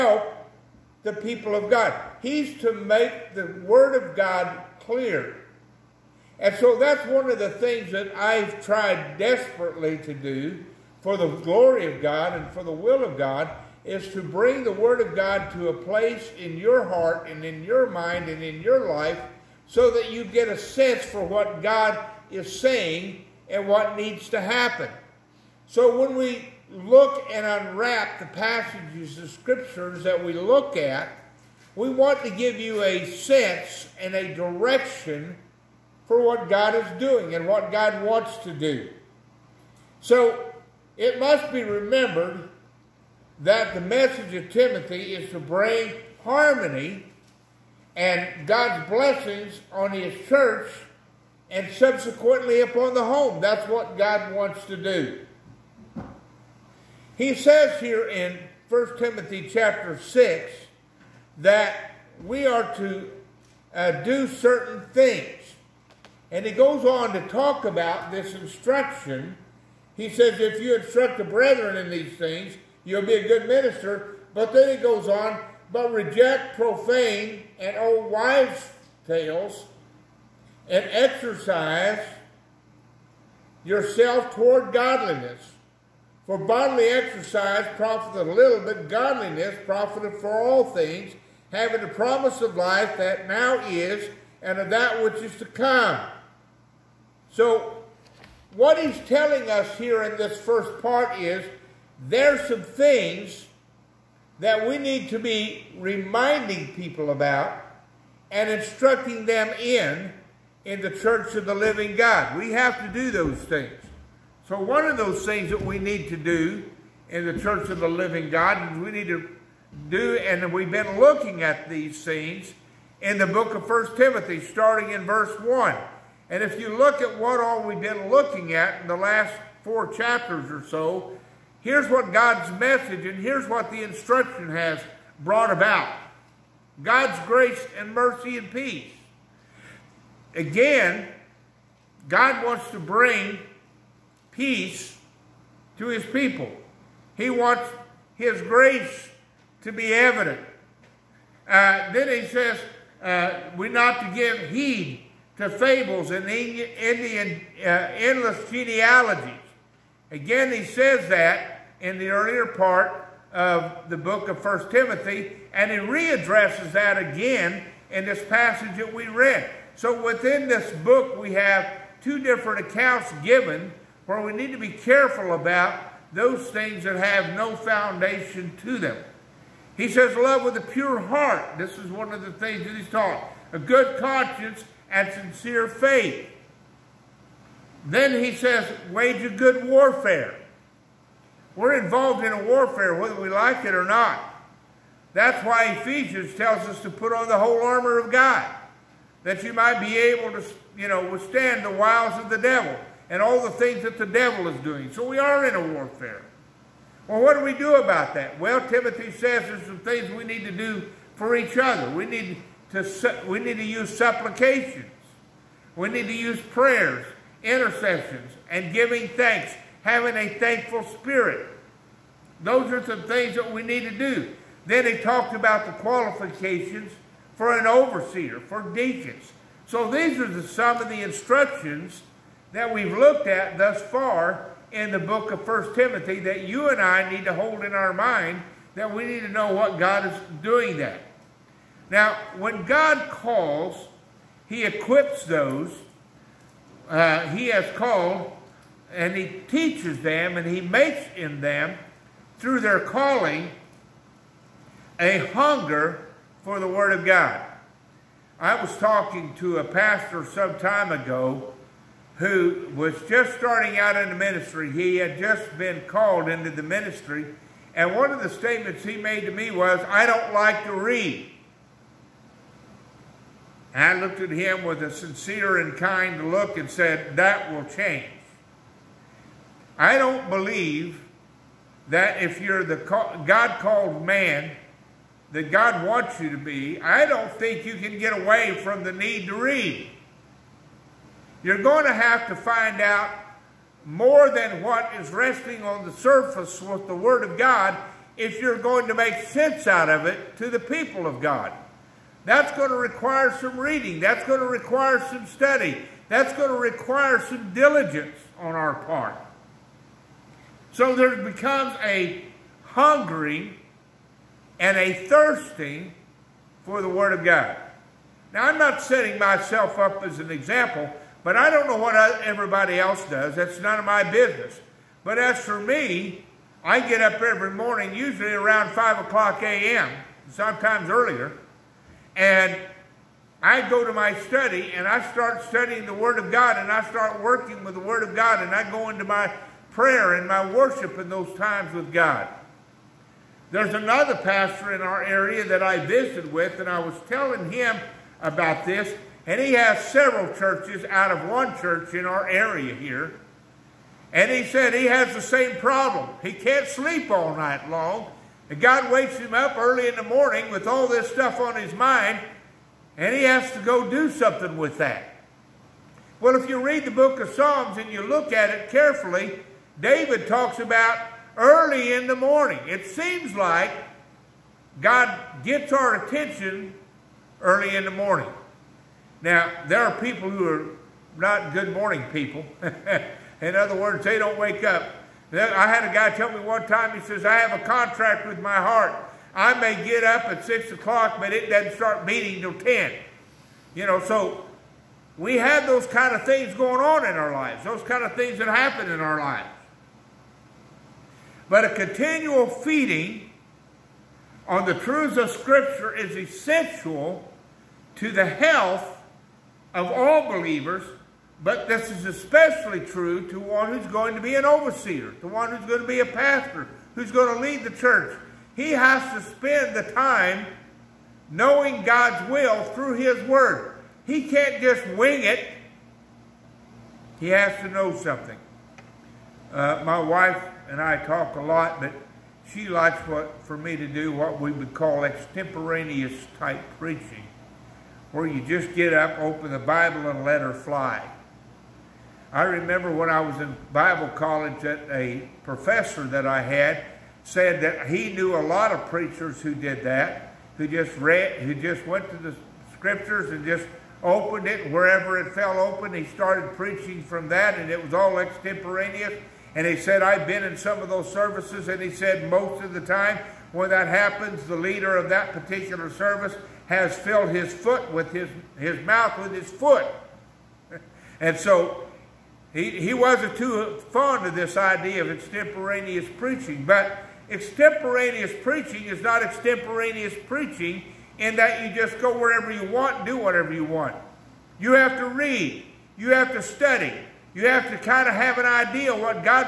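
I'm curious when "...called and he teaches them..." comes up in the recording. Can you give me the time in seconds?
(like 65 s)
247 s.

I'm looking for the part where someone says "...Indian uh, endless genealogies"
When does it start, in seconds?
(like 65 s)
156 s.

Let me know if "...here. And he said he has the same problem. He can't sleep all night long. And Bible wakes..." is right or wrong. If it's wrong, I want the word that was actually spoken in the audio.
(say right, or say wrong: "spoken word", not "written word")
wrong: "God", not "Bible".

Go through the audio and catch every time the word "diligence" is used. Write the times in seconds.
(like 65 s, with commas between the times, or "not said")
307 s.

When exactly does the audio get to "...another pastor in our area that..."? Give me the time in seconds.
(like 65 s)
343 s.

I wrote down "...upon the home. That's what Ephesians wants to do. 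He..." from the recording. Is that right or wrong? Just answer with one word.
wrong.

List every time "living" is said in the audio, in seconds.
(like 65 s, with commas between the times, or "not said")
111 s, 117 s.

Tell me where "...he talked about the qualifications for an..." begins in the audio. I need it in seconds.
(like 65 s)
224 s.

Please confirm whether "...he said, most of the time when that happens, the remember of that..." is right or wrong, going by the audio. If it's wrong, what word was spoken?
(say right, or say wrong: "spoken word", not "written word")
wrong: "leader", not "remember".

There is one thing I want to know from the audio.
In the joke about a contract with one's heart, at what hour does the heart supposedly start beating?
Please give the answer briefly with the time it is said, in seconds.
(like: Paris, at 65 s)
10, at 392 s.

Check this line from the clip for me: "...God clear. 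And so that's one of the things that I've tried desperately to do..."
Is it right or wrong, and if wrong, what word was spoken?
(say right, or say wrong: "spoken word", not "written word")
right.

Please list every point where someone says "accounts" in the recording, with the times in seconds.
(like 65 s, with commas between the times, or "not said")
172 s.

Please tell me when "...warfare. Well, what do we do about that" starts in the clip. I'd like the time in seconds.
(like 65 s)
205 s.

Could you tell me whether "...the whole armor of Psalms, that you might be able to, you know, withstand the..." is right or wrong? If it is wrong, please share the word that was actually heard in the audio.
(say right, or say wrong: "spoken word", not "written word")
wrong: "God", not "Psalms".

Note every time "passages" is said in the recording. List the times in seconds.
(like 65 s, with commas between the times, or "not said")
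28 s, 168 s.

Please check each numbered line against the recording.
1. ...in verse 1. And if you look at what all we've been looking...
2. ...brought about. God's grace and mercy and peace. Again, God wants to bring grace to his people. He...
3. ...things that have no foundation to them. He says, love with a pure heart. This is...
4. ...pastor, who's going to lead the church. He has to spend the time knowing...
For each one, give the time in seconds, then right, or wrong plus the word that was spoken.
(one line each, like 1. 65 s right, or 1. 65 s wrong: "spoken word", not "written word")
1. 124 s right
2. 135 s wrong: "peace", not "grace"
3. 176 s right
4. 416 s right.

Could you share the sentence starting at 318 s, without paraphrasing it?
Now, I'm not setting myself up as an example but I don't know what I, everybody else does.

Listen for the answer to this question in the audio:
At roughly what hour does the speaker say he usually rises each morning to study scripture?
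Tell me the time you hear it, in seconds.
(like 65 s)
328 s.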